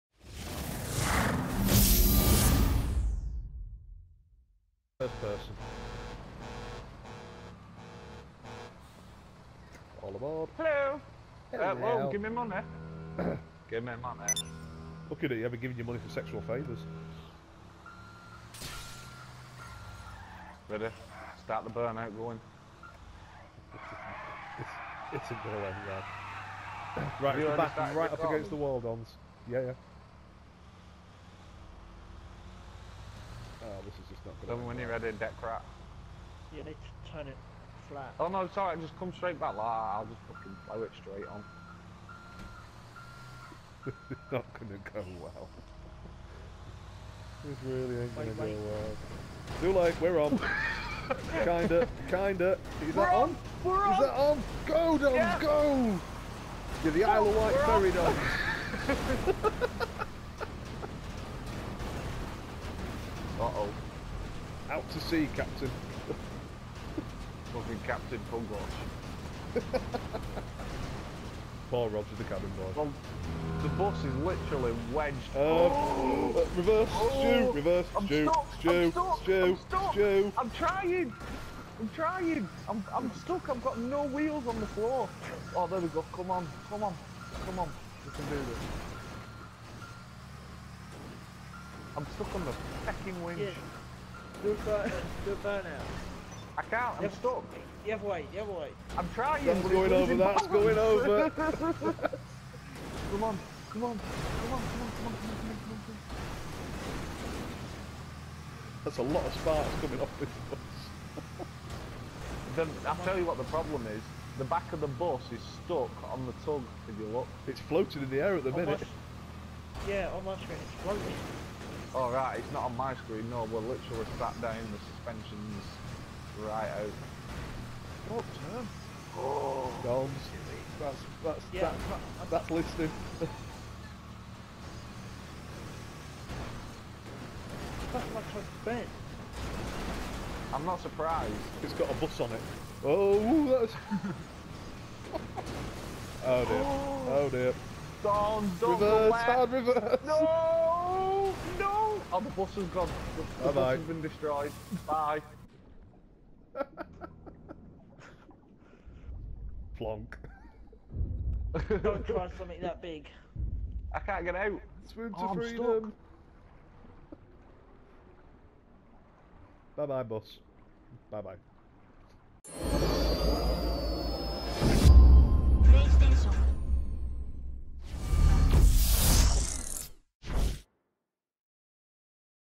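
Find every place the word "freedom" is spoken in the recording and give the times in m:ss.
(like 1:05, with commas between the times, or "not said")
2:45.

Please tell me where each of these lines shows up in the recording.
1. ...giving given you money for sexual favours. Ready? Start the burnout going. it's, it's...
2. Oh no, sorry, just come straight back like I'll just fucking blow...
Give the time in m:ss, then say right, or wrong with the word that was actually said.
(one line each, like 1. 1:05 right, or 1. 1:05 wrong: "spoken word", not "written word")
1. 0:15 right
2. 0:38 right.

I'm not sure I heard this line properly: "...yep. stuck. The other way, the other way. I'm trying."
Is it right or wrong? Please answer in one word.
right.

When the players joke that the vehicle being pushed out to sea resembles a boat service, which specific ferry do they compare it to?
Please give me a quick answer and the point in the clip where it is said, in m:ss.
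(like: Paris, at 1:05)
Isle of Wight ferry, at 0:57.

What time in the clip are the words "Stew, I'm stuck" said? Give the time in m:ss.
1:18.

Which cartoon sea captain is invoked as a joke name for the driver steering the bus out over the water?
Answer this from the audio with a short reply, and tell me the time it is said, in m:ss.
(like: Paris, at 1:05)
Captain Pugwash, at 1:07.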